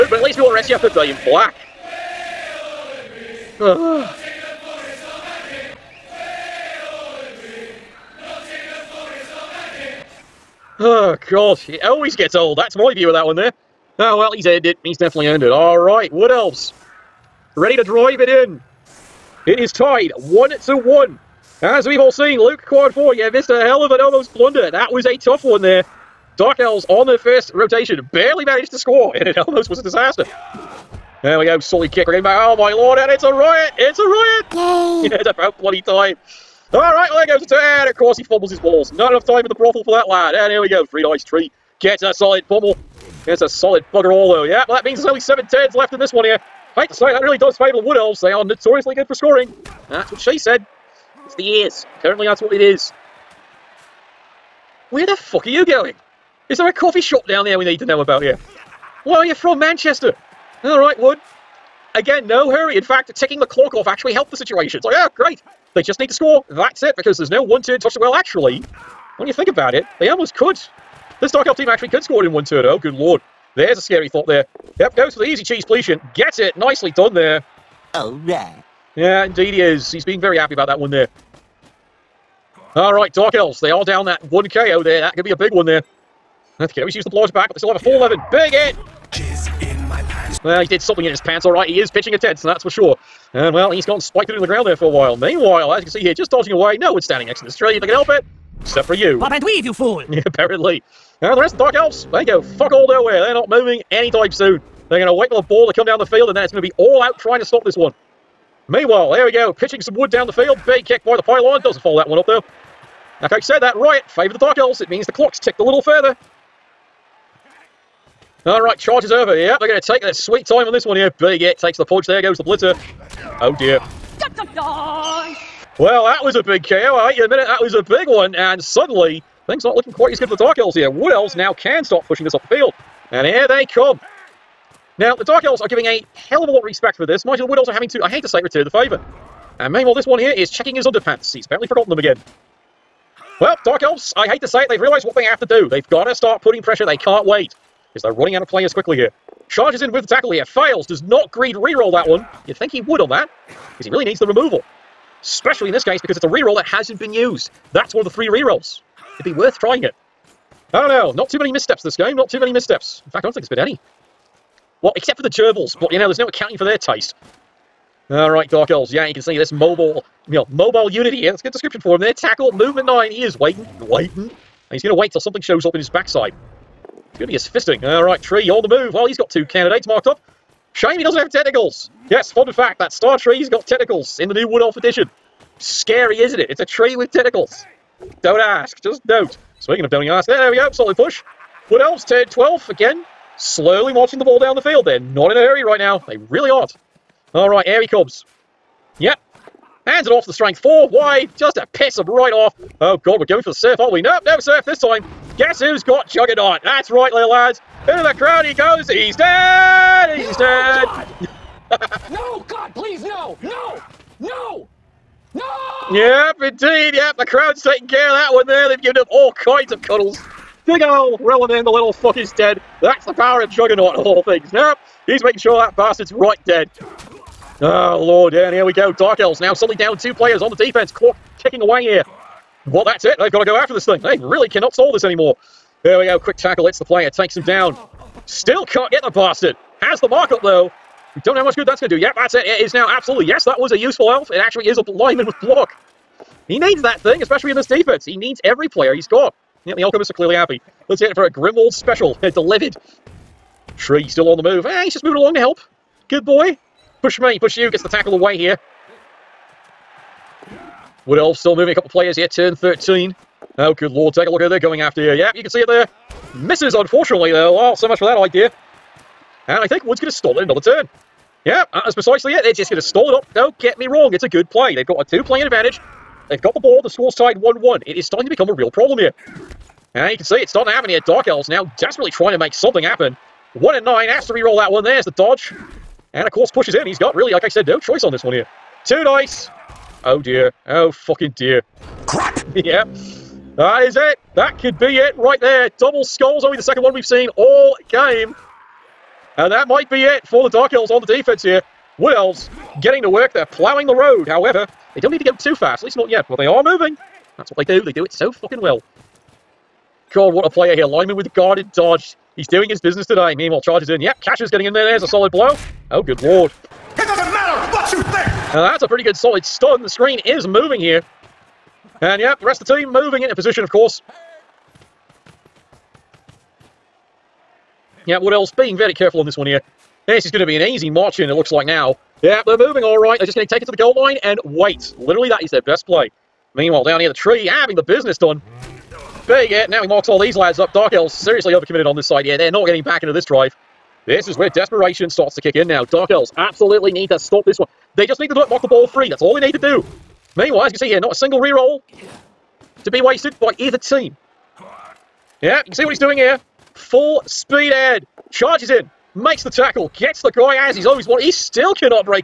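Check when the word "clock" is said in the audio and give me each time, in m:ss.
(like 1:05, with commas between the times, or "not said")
1:03, 1:55, 3:50.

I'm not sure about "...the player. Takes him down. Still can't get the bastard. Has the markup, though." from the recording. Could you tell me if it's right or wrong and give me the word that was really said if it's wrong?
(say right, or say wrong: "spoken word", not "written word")
right.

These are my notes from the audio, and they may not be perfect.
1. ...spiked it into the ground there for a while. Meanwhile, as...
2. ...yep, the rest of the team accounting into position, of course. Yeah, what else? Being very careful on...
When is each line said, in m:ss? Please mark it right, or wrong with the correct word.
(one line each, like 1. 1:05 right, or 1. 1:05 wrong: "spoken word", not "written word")
1. 1:33 right
2. 5:22 wrong: "moving", not "accounting".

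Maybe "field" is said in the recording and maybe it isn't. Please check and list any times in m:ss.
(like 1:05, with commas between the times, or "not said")
1:46, 1:50, 2:12, 3:14.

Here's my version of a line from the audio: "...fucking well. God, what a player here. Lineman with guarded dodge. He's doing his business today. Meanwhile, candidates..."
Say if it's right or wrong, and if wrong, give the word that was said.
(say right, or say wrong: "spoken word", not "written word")
wrong: "charges", not "candidates".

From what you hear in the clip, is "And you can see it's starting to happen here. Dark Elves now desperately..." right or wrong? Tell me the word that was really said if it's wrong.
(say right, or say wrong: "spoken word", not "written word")
right.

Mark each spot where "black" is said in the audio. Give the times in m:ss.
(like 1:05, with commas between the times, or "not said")
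0:01.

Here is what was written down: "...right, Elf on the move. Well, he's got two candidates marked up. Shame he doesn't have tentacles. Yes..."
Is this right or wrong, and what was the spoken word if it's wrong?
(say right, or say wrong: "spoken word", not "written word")
wrong: "Tree", not "Elf".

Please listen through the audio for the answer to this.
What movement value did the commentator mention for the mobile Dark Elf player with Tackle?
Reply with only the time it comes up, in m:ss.
2:52.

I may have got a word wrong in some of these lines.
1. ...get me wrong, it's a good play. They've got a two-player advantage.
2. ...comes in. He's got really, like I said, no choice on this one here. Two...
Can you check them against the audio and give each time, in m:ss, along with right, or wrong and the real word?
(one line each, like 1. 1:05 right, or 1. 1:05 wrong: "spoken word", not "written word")
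1. 4:33 right
2. 4:46 wrong: "pushes", not "comes".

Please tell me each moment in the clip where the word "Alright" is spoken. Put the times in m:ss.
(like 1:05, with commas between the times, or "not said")
0:36, 1:00, 2:48.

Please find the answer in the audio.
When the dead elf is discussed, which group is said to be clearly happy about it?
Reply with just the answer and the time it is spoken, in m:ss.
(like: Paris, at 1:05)
The Alchemists, at 4:09.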